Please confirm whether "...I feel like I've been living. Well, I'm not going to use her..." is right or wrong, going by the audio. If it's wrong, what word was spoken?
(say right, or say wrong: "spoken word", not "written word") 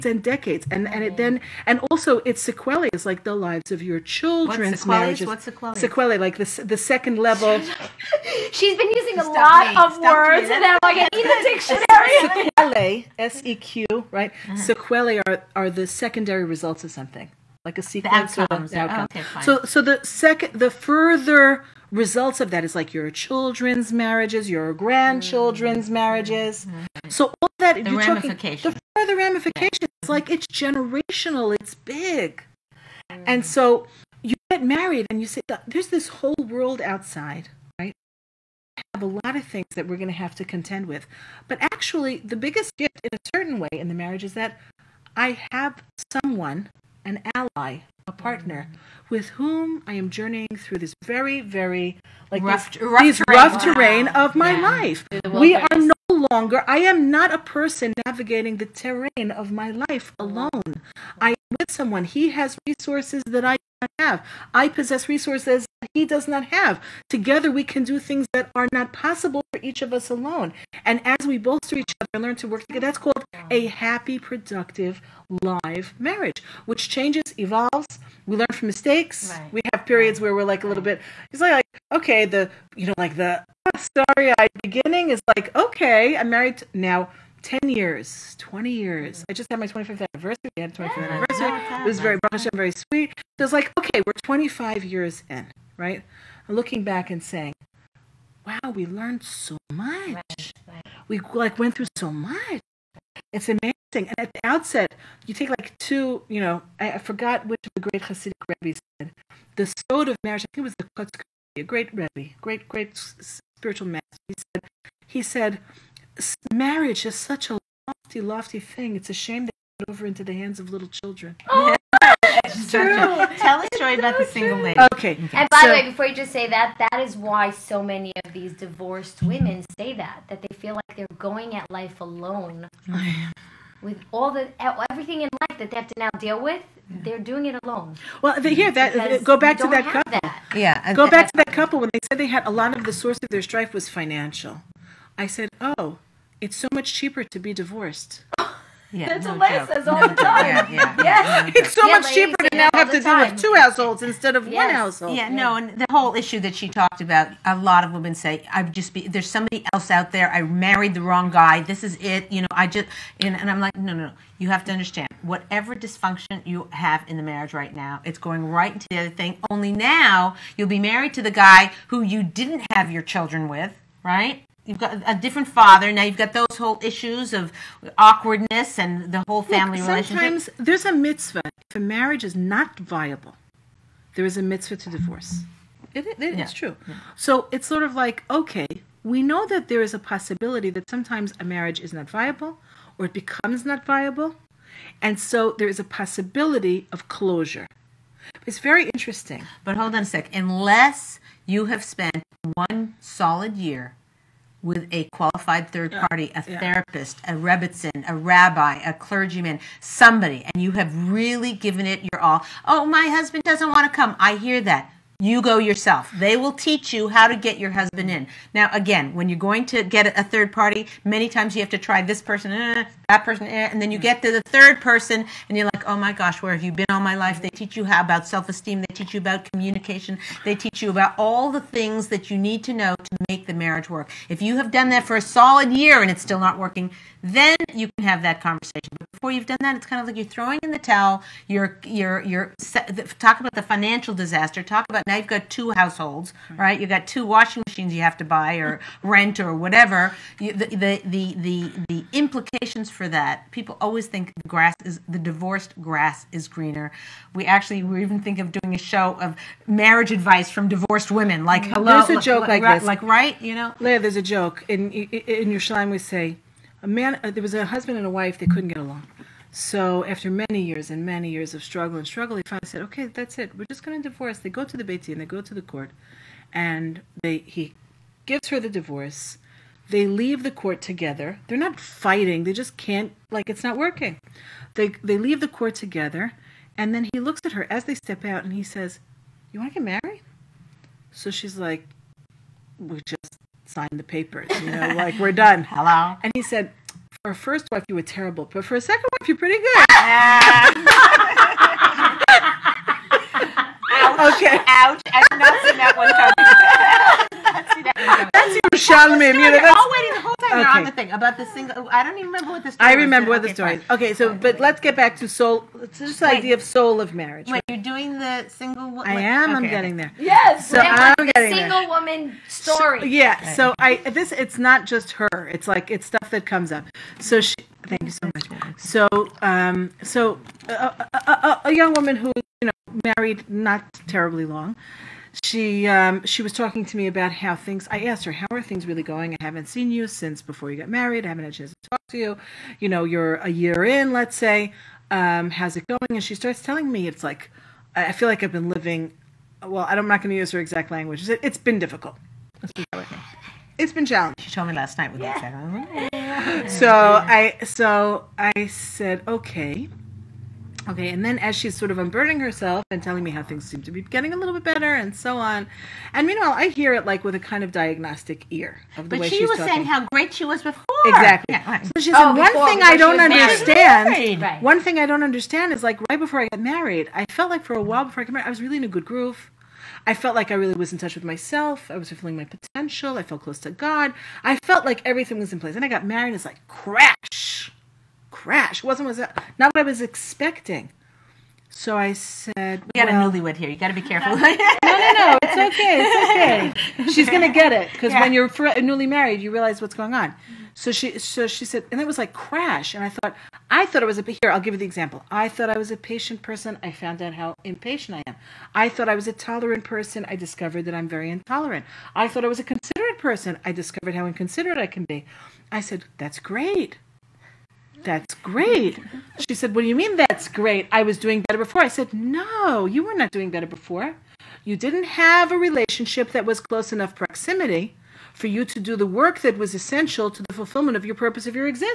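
right.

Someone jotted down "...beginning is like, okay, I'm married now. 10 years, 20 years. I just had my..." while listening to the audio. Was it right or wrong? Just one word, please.
right.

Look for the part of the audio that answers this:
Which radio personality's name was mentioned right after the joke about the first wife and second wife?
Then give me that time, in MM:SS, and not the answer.
05:08.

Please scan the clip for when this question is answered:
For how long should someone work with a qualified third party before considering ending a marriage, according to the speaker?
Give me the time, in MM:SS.
03:22.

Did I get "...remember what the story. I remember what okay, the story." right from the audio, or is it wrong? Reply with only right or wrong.
right.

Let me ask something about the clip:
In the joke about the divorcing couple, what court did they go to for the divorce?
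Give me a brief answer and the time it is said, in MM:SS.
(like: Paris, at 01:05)
beis din, at 04:34.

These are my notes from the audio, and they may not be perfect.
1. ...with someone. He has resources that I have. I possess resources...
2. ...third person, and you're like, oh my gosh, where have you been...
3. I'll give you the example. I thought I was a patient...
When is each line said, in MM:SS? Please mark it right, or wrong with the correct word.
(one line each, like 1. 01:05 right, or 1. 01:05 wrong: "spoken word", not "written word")
1. 01:01 right
2. 03:44 right
3. 06:44 right.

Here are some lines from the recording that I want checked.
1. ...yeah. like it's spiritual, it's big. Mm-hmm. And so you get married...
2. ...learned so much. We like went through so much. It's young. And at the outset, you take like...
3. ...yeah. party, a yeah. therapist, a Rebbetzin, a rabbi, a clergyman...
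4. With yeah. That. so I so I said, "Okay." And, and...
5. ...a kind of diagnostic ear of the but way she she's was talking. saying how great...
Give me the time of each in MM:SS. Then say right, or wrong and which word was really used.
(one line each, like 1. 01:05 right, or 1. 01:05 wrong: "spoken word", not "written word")
1. 00:30 wrong: "generational", not "spiritual"
2. 01:38 wrong: "amazing", not "young"
3. 03:25 right
4. 05:55 wrong: "Okay", not "And"
5. 06:07 right.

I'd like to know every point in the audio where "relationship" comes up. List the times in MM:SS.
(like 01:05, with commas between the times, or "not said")
03:00, 07:05.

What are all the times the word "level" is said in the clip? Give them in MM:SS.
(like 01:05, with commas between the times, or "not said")
00:07.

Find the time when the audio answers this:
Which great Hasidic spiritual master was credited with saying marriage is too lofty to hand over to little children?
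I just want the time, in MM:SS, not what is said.
01:50.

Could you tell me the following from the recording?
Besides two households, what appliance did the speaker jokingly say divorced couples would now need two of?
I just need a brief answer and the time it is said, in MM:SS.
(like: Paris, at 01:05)
washing machines, at 04:07.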